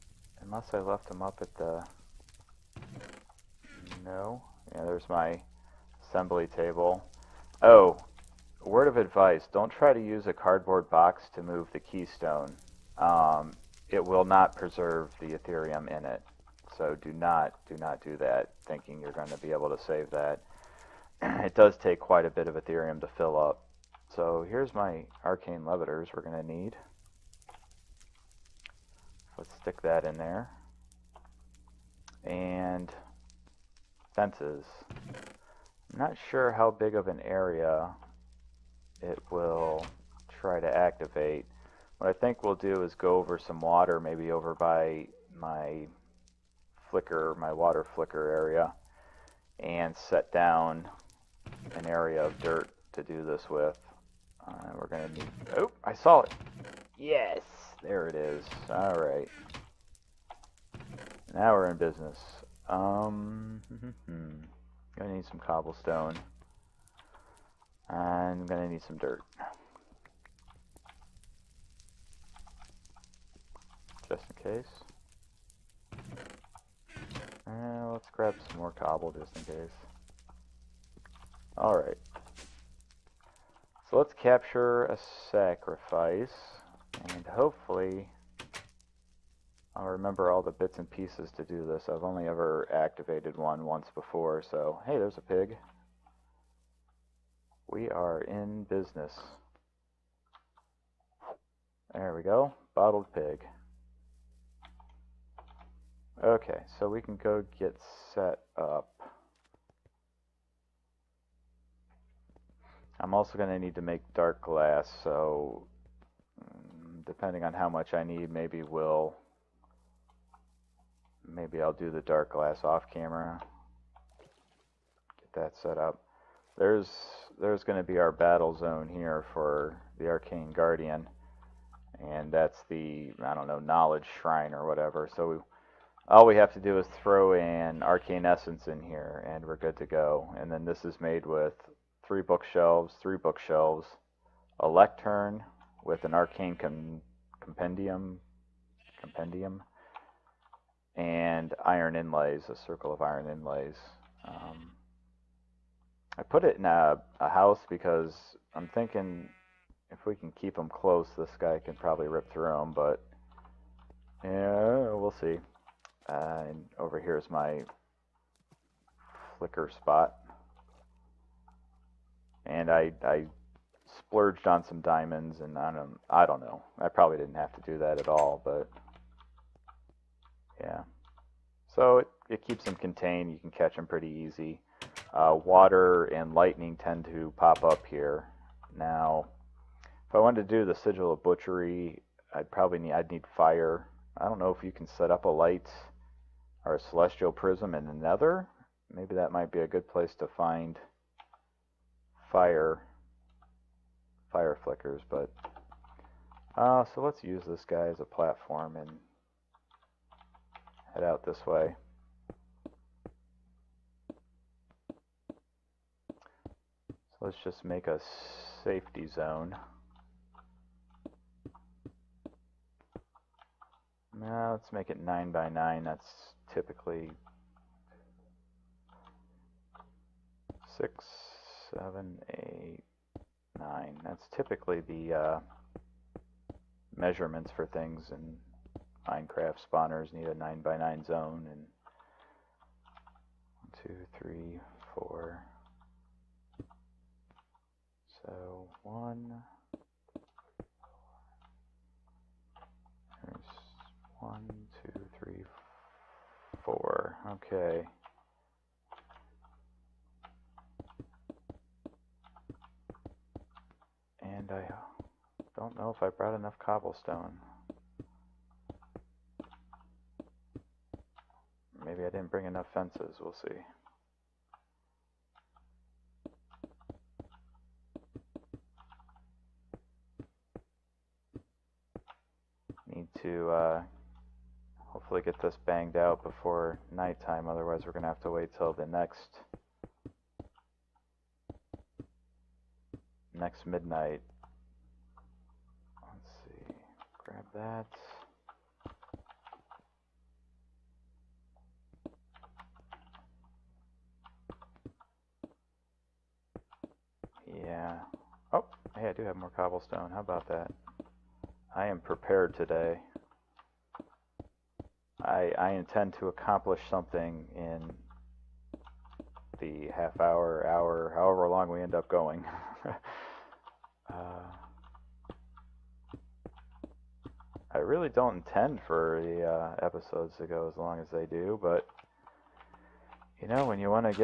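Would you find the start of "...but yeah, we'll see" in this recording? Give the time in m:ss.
2:42.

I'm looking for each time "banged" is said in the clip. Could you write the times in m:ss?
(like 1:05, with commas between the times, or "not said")
4:45.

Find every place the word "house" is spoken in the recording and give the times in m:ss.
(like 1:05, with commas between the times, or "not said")
2:37.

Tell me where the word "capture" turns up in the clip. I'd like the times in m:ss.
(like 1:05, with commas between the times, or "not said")
1:24.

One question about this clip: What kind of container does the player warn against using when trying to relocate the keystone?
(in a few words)
Cardboard box.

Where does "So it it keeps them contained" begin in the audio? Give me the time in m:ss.
3:01.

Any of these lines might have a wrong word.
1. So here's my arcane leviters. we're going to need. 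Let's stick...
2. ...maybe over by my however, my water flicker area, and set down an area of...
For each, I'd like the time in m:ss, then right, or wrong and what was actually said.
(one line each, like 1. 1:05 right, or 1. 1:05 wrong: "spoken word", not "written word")
1. 0:24 right
2. 0:43 wrong: "flicker", not "however".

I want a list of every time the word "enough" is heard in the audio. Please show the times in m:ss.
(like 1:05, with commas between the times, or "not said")
4:26, 4:32.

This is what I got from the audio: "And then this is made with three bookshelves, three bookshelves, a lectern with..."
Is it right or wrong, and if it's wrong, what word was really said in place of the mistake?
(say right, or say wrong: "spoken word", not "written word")
right.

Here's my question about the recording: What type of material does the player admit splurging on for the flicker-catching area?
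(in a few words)
Diamonds.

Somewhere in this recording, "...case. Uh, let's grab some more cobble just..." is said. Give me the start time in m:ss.
1:14.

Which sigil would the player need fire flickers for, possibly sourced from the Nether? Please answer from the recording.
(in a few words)
Sigil of butchery.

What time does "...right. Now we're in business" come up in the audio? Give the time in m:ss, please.
0:58.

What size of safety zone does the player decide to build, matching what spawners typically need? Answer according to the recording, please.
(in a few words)
9 by 9.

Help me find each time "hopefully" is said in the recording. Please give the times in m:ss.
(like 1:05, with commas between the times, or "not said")
1:27, 4:44.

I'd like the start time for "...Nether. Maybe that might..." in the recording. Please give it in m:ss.
3:17.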